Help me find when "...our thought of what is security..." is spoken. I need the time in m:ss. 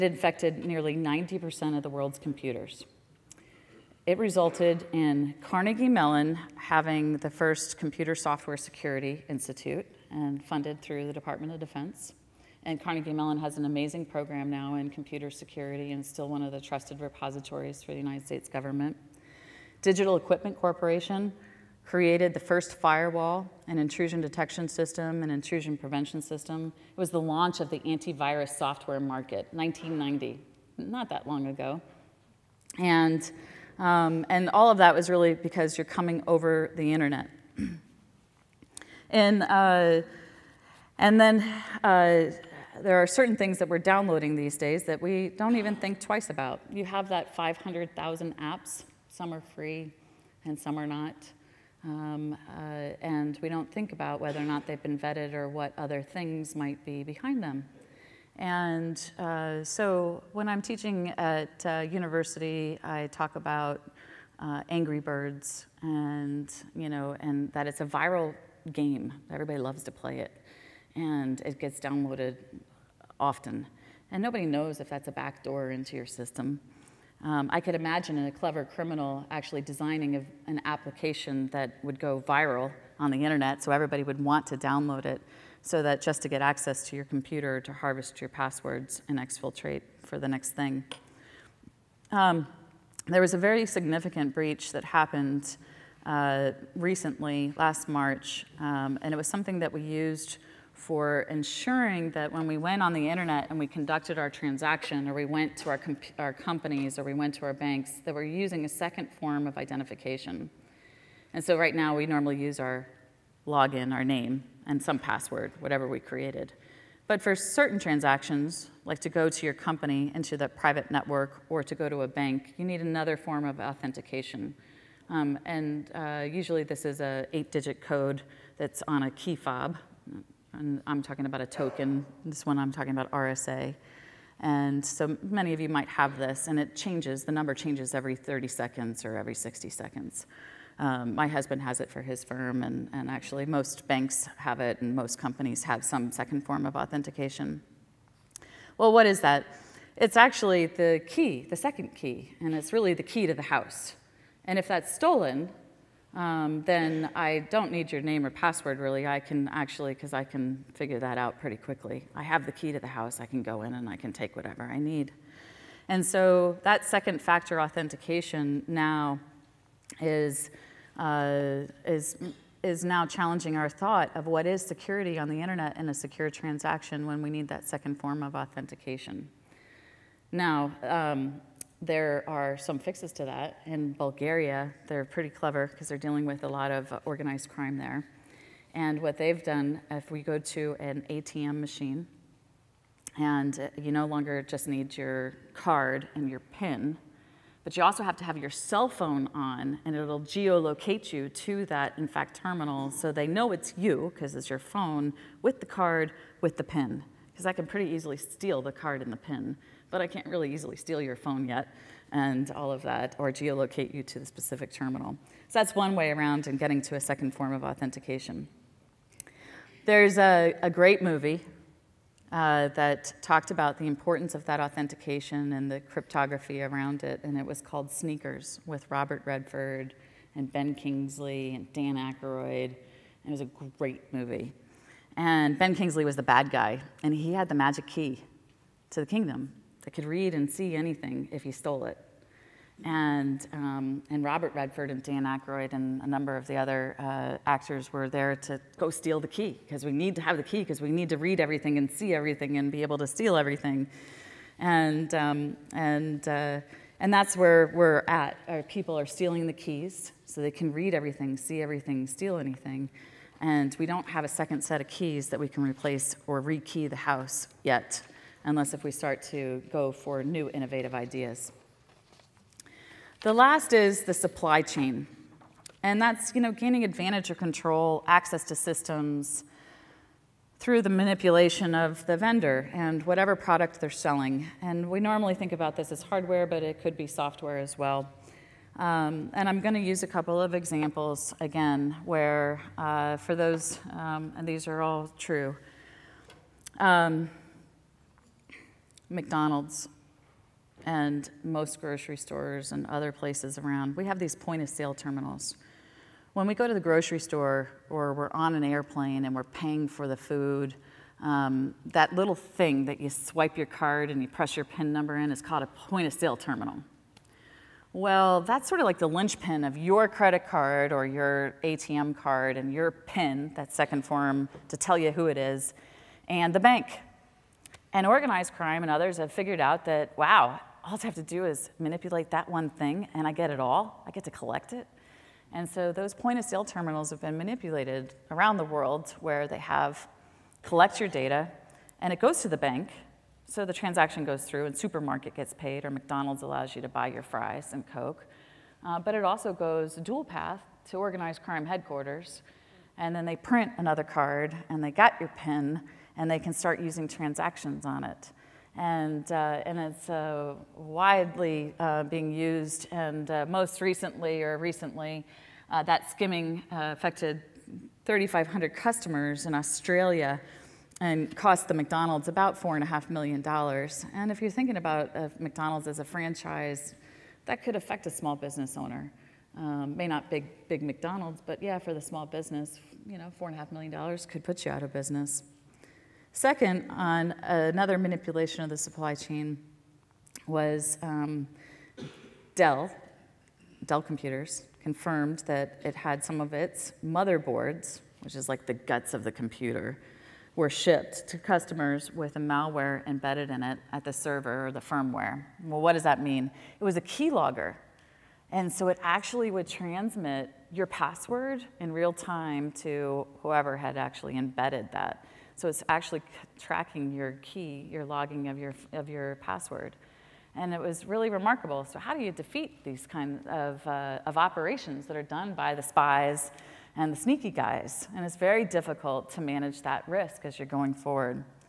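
2:53.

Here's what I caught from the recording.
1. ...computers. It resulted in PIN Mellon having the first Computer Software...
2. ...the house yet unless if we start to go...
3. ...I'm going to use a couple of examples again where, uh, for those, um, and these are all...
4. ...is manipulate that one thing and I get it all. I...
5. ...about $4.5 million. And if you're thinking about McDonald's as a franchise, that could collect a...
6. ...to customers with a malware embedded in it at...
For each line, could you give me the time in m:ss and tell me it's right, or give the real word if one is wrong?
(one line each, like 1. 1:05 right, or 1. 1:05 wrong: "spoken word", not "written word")
1. 0:02 wrong: "Carnegie", not "PIN"
2. 4:26 right
3. 4:49 right
4. 5:31 right
5. 6:12 wrong: "affect", not "collect"
6. 6:41 right.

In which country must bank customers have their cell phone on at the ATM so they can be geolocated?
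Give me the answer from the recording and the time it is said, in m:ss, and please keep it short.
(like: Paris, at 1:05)
Bulgaria, at 3:03.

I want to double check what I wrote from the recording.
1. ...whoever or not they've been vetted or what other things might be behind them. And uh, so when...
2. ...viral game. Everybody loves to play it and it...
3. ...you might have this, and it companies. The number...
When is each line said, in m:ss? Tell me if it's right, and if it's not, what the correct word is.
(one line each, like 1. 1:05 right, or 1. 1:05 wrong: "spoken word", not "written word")
1. 0:54 wrong: "whether", not "whoever"
2. 1:07 right
3. 2:15 wrong: "changes", not "companies".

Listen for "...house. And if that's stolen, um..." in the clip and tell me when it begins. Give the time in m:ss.
2:33.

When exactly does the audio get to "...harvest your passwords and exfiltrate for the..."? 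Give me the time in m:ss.
1:27.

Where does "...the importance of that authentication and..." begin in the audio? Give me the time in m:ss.
3:43.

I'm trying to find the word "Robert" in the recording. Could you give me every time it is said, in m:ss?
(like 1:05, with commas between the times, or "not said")
3:48, 4:04.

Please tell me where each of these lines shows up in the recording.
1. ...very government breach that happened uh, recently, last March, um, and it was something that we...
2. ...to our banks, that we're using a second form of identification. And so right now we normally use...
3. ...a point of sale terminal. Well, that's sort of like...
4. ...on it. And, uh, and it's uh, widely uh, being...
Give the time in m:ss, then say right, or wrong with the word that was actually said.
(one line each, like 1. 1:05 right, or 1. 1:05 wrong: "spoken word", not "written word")
1. 1:33 wrong: "significant", not "government"
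2. 1:47 right
3. 5:15 right
4. 5:57 right.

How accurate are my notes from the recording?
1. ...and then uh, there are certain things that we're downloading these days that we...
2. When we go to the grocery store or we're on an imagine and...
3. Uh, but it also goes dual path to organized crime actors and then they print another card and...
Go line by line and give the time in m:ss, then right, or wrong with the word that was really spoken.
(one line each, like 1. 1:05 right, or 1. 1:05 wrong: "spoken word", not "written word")
1. 0:40 right
2. 5:06 wrong: "airplane", not "imagine"
3. 5:48 wrong: "headquarters", not "actors".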